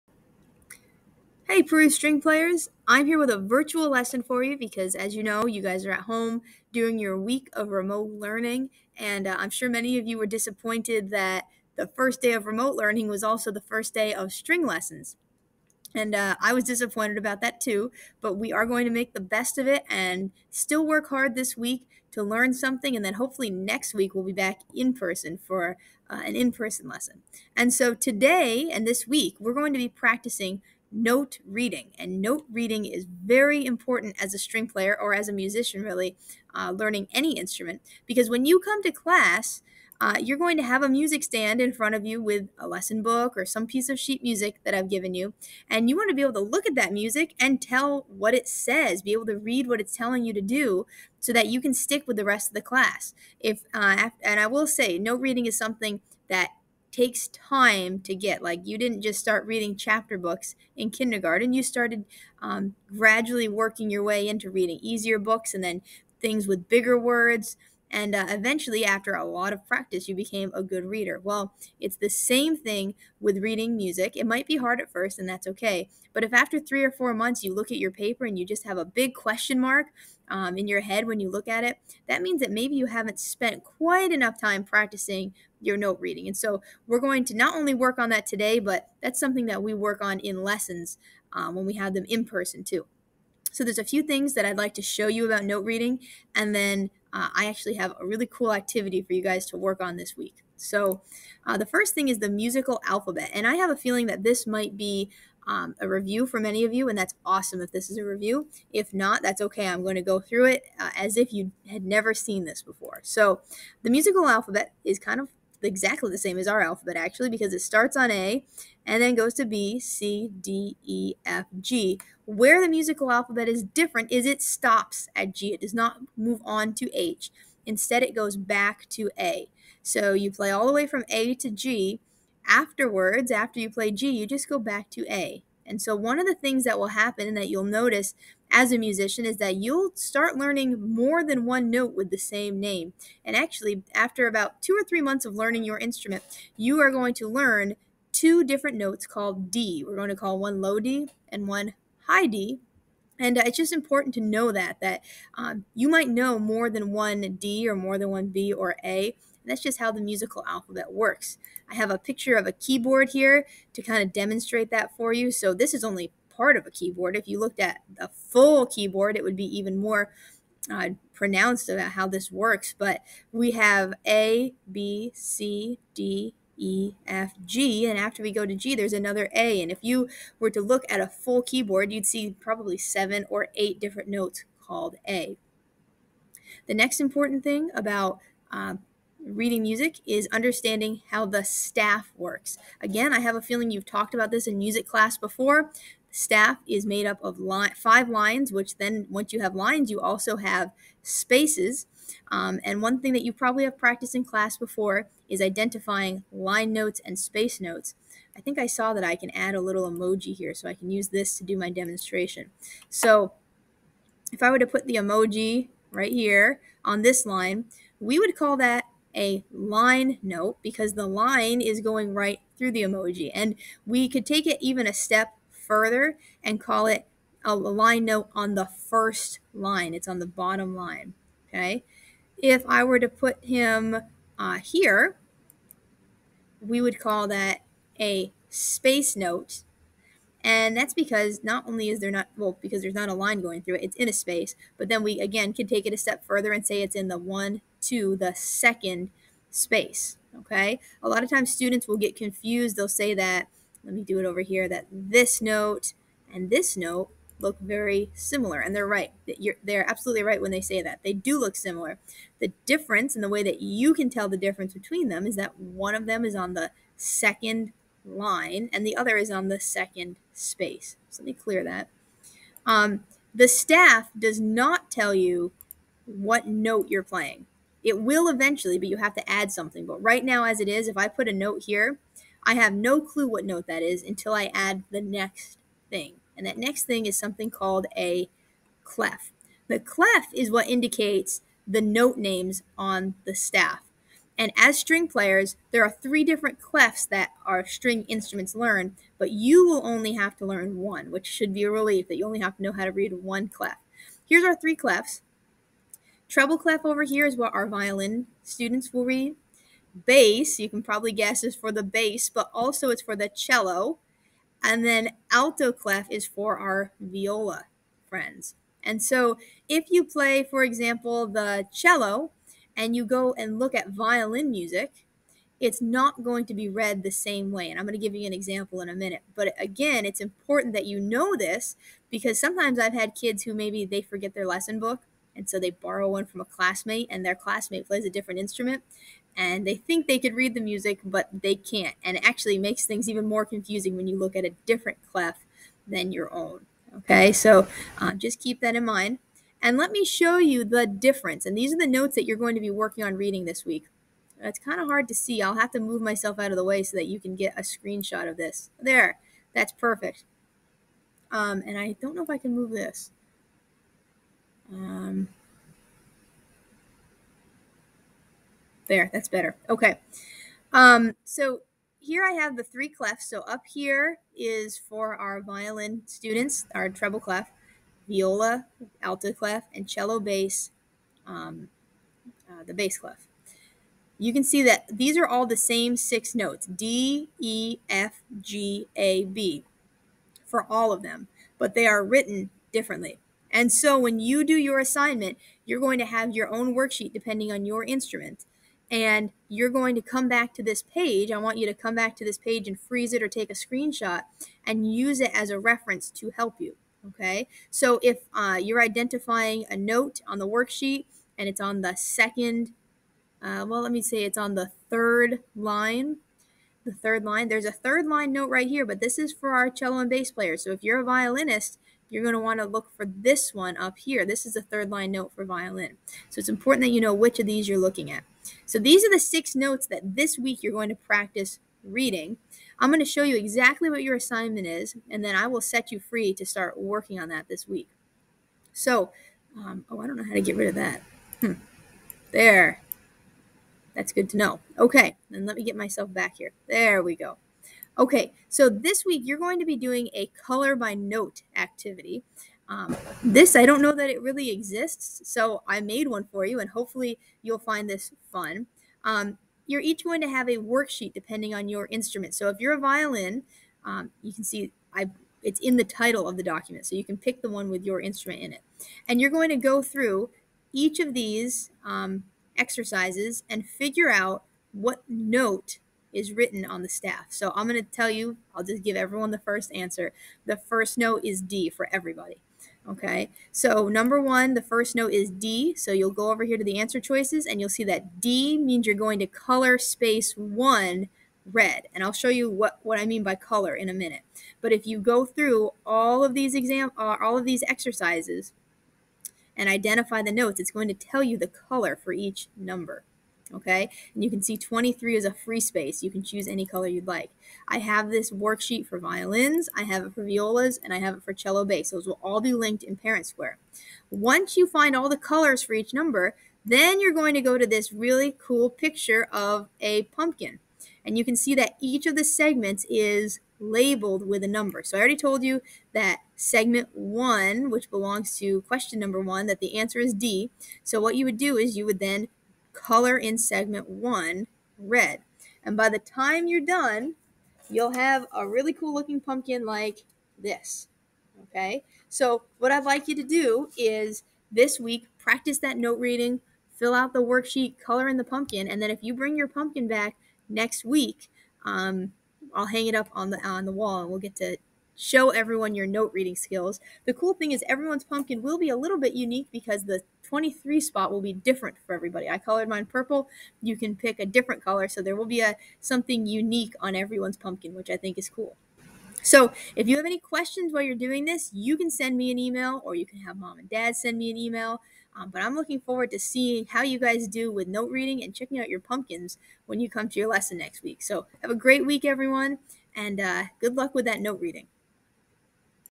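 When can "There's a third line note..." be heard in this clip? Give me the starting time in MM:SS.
06:57.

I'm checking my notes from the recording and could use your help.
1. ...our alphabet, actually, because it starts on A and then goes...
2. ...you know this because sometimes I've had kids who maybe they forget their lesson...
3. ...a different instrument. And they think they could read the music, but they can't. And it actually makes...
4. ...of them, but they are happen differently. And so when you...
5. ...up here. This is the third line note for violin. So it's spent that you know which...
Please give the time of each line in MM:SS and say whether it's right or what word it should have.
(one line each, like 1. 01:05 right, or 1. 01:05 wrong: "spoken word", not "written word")
1. 01:56 right
2. 05:30 right
3. 05:38 right
4. 06:30 wrong: "written", not "happen"
5. 07:03 wrong: "important", not "spent".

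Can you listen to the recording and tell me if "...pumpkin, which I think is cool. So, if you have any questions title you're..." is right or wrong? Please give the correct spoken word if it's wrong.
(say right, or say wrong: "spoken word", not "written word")
wrong: "while", not "title".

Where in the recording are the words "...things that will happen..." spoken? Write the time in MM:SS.
02:16.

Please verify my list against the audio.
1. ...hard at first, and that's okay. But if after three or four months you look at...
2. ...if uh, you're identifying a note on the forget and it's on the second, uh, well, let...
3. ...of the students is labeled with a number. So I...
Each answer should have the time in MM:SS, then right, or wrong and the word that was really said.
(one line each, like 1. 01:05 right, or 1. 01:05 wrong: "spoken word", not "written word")
1. 01:14 right
2. 06:48 wrong: "worksheet", not "forget"
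3. 08:42 wrong: "segments", not "students".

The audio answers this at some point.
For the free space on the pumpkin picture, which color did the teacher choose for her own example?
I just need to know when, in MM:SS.
09:22.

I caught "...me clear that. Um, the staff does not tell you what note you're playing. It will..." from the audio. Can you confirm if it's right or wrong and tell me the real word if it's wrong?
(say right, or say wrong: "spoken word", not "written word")
right.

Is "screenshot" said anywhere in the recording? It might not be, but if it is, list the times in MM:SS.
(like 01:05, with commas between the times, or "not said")
05:57, 06:43.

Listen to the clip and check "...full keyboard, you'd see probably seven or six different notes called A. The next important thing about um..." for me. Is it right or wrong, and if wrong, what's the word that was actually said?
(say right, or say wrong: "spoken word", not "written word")
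wrong: "eight", not "six".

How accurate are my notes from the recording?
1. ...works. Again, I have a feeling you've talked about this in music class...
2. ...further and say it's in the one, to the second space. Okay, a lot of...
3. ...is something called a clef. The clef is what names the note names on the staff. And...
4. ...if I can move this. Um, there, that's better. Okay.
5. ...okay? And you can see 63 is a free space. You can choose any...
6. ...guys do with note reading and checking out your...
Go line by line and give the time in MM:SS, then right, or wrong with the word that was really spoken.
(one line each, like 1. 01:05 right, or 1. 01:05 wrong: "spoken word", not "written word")
1. 03:12 right
2. 04:06 right
3. 04:47 wrong: "indicates", not "names"
4. 06:02 right
5. 08:23 wrong: "23", not "63"
6. 09:36 right.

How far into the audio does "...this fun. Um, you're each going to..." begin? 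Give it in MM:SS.
07:37.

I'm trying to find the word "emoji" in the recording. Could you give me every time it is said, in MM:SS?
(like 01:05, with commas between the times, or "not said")
03:29, 03:34, 03:42.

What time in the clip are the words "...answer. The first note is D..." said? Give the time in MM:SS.
07:59.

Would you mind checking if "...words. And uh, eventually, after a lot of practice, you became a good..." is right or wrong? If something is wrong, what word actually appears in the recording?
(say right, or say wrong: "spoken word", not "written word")
right.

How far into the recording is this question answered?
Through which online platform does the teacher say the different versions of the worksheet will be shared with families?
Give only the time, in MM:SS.
08:32.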